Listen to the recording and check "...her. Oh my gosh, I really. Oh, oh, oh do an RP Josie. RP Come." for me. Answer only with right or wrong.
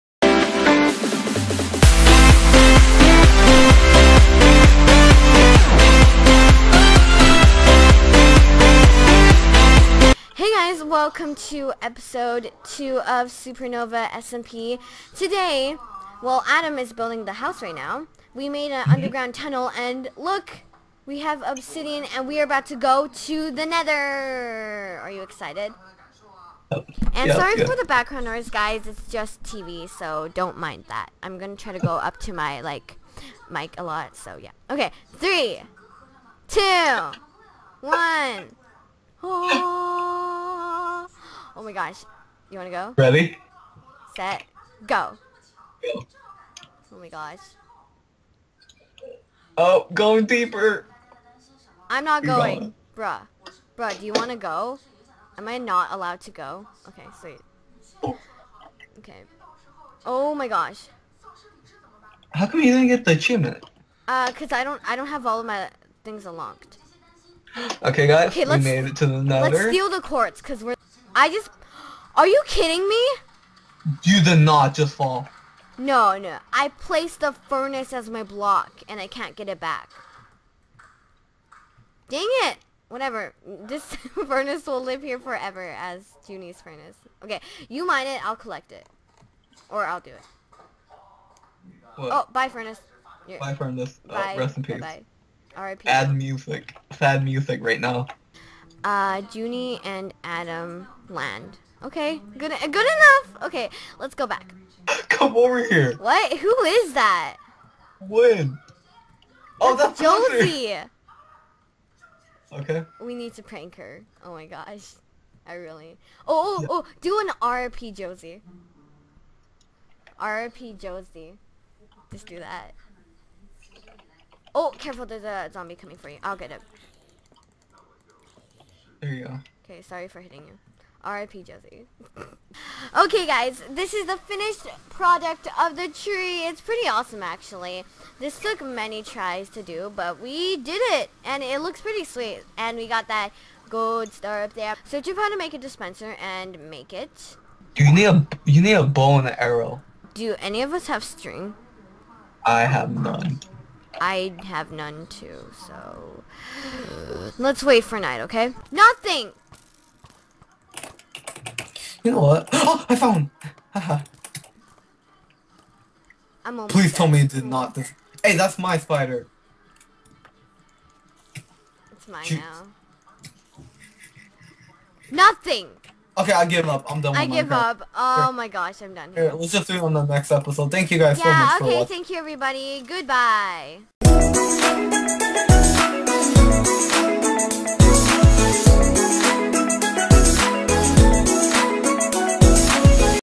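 wrong.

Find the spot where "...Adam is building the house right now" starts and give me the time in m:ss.
0:16.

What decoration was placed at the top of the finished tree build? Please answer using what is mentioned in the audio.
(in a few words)
Gold star.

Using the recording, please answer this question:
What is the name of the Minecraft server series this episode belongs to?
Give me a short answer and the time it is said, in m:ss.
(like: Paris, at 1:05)
Supernova SMP, at 0:13.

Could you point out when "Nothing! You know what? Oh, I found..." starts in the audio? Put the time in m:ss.
2:38.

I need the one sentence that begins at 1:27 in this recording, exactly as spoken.
Okay, you mine it, I'll collect it.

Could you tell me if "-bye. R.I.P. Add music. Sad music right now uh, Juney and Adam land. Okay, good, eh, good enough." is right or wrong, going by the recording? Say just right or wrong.
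right.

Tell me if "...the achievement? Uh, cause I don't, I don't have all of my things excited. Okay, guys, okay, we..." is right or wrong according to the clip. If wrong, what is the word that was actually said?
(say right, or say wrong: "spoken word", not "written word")
wrong: "unlocked", not "excited".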